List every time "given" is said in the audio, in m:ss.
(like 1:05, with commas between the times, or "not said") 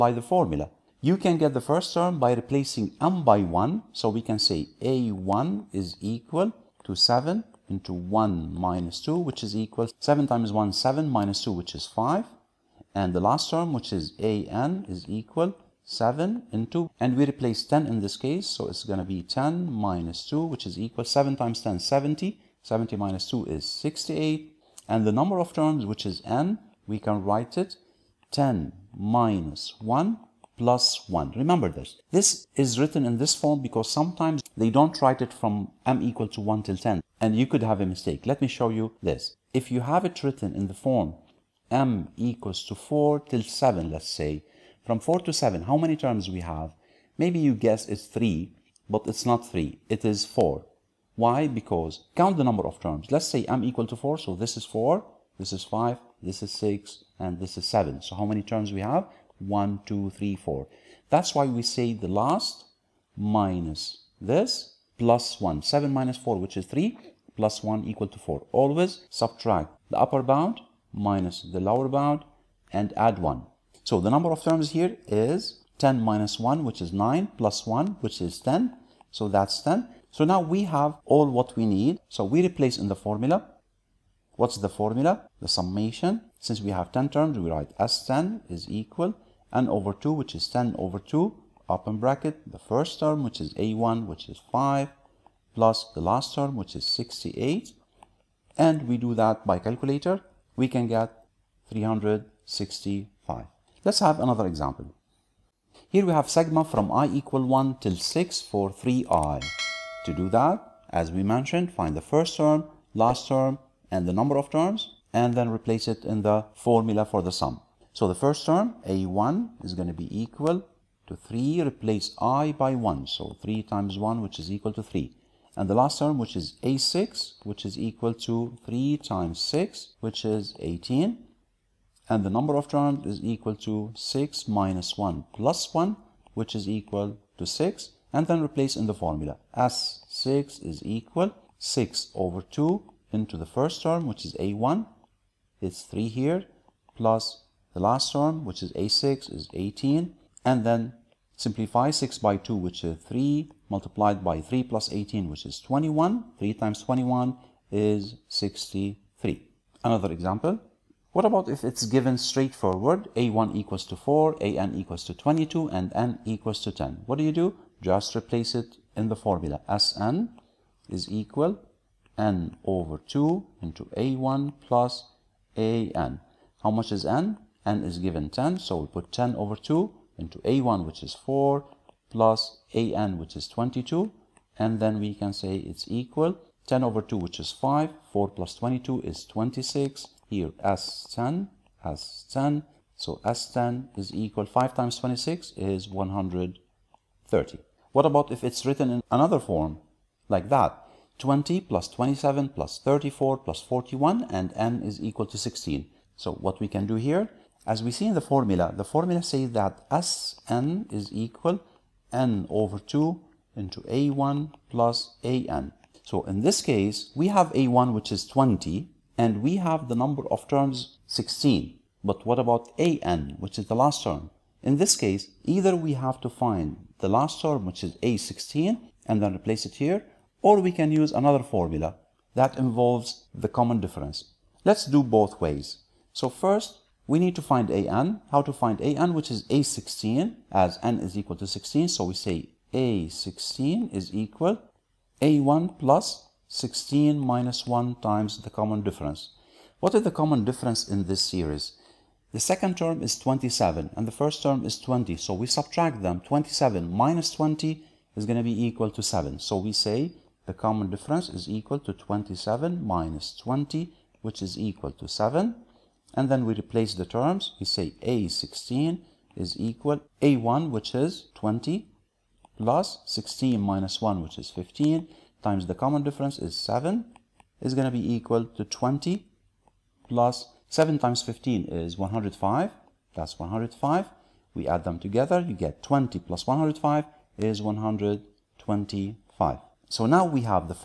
2:41, 2:57.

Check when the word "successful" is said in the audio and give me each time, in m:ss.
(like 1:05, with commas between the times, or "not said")
not said.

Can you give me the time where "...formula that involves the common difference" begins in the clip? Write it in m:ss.
3:51.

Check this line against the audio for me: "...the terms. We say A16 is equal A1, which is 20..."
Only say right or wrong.
right.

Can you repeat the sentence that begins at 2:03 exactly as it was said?
So 3 times 1, which is equal to 3.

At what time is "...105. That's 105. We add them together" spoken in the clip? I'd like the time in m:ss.
4:41.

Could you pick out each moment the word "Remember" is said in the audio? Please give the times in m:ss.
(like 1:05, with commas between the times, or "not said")
0:31.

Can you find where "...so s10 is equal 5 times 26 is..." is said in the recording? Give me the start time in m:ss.
3:12.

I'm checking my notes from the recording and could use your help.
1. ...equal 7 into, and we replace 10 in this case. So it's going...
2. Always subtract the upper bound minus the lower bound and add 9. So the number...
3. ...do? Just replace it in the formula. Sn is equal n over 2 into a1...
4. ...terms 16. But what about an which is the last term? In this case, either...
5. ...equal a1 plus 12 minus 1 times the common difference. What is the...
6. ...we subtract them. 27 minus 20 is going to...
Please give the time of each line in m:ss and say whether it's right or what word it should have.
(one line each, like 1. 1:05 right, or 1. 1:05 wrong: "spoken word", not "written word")
1. 0:15 right
2. 1:08 wrong: "1", not "9"
3. 2:47 right
4. 3:40 right
5. 4:04 wrong: "16", not "12"
6. 4:15 right.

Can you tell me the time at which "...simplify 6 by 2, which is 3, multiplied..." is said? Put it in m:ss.
2:31.